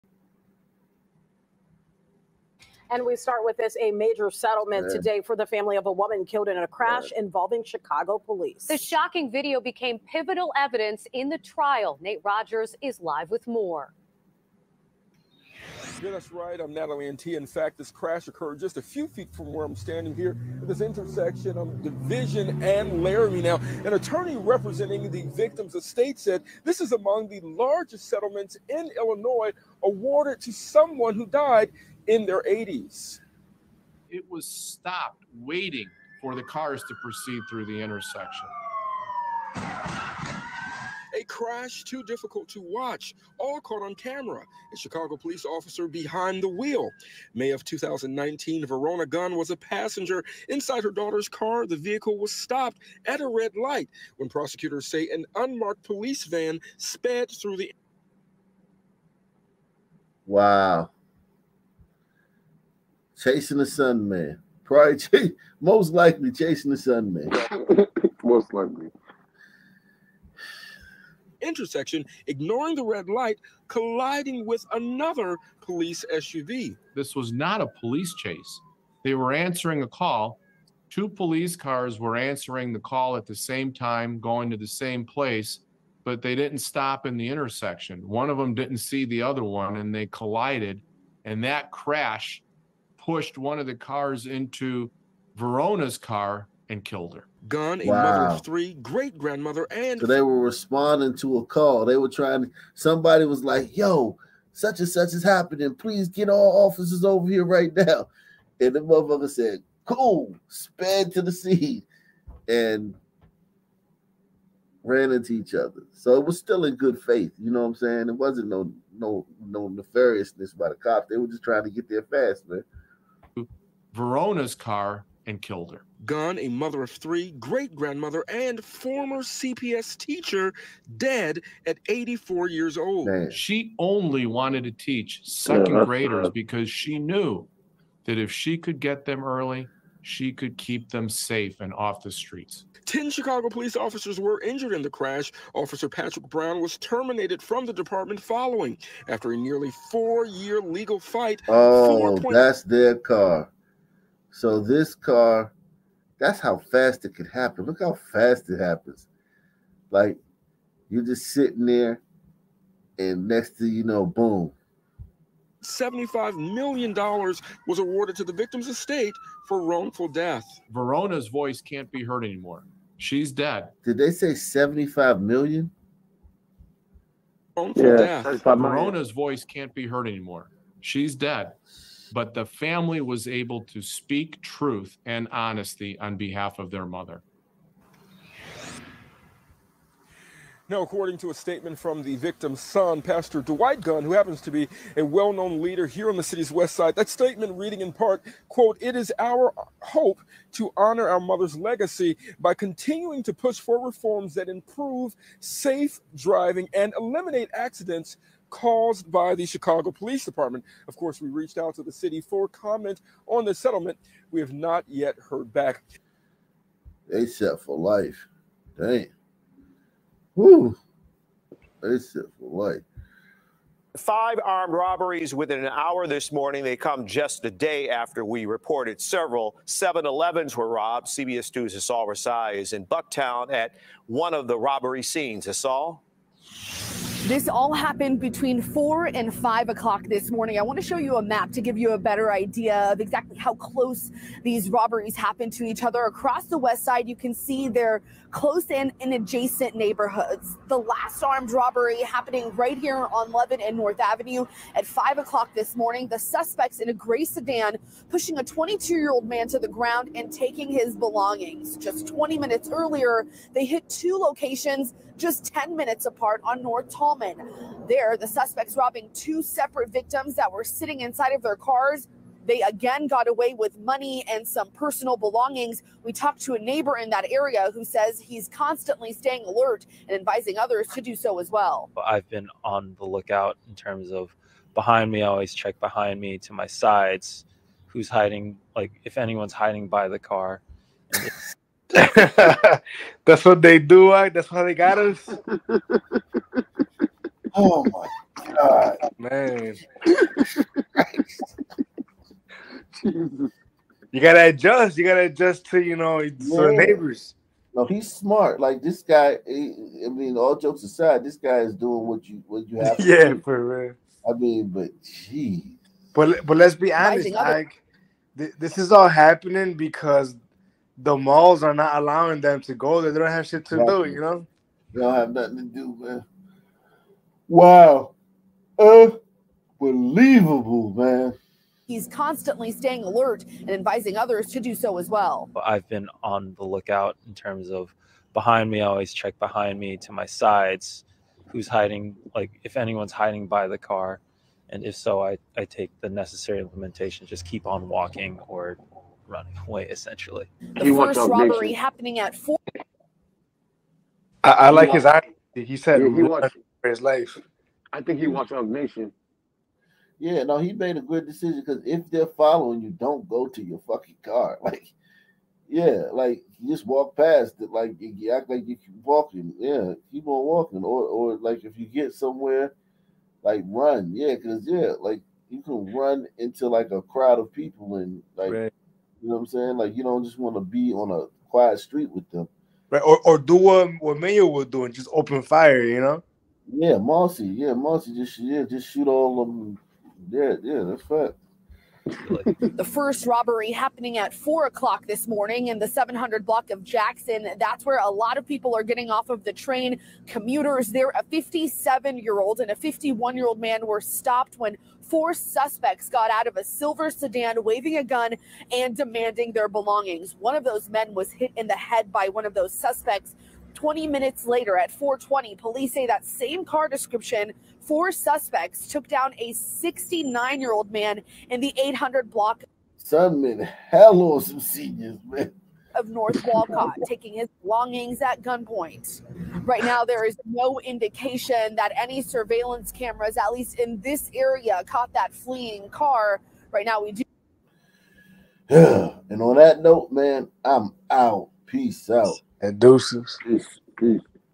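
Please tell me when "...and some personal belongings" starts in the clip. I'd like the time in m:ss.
4:34.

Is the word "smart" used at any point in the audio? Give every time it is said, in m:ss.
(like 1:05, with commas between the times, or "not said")
5:08.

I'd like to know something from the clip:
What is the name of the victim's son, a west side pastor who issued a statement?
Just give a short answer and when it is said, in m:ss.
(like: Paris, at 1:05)
Dwight Gunn, at 3:13.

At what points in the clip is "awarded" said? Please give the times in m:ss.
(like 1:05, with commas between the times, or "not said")
0:29, 2:47.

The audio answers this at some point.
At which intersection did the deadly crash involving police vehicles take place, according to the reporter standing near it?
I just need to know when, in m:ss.
0:21.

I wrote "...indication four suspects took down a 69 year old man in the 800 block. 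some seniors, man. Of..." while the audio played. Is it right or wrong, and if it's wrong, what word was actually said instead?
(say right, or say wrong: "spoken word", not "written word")
wrong: "description", not "indication".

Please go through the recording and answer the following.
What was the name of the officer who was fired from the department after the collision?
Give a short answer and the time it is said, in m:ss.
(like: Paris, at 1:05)
Patrick Brown, at 2:25.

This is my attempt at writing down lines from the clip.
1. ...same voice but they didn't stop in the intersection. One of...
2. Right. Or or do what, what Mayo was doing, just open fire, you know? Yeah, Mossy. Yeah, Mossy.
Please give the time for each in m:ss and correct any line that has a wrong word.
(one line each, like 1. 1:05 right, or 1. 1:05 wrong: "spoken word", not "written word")
1. 1:24 wrong: "place", not "voice"
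2. 6:22 right.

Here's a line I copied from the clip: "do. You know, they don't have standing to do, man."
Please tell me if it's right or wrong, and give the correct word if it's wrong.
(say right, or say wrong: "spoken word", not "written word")
wrong: "nothing", not "standing".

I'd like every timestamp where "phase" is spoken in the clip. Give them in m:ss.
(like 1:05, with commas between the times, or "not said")
not said.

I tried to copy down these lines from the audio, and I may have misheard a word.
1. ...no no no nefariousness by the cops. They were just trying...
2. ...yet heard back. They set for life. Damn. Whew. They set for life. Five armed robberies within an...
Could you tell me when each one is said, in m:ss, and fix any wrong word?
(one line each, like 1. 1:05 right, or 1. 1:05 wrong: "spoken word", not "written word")
1. 1:58 right
2. 3:34 right.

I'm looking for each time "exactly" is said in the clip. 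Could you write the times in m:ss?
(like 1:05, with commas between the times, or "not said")
4:02, 5:23.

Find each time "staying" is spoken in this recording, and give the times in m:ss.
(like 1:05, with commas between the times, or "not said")
4:39, 5:32.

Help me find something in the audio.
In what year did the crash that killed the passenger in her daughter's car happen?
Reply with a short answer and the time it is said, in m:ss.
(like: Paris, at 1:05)
2019, at 0:47.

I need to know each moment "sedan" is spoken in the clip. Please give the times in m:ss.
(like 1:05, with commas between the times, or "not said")
4:17, 6:47.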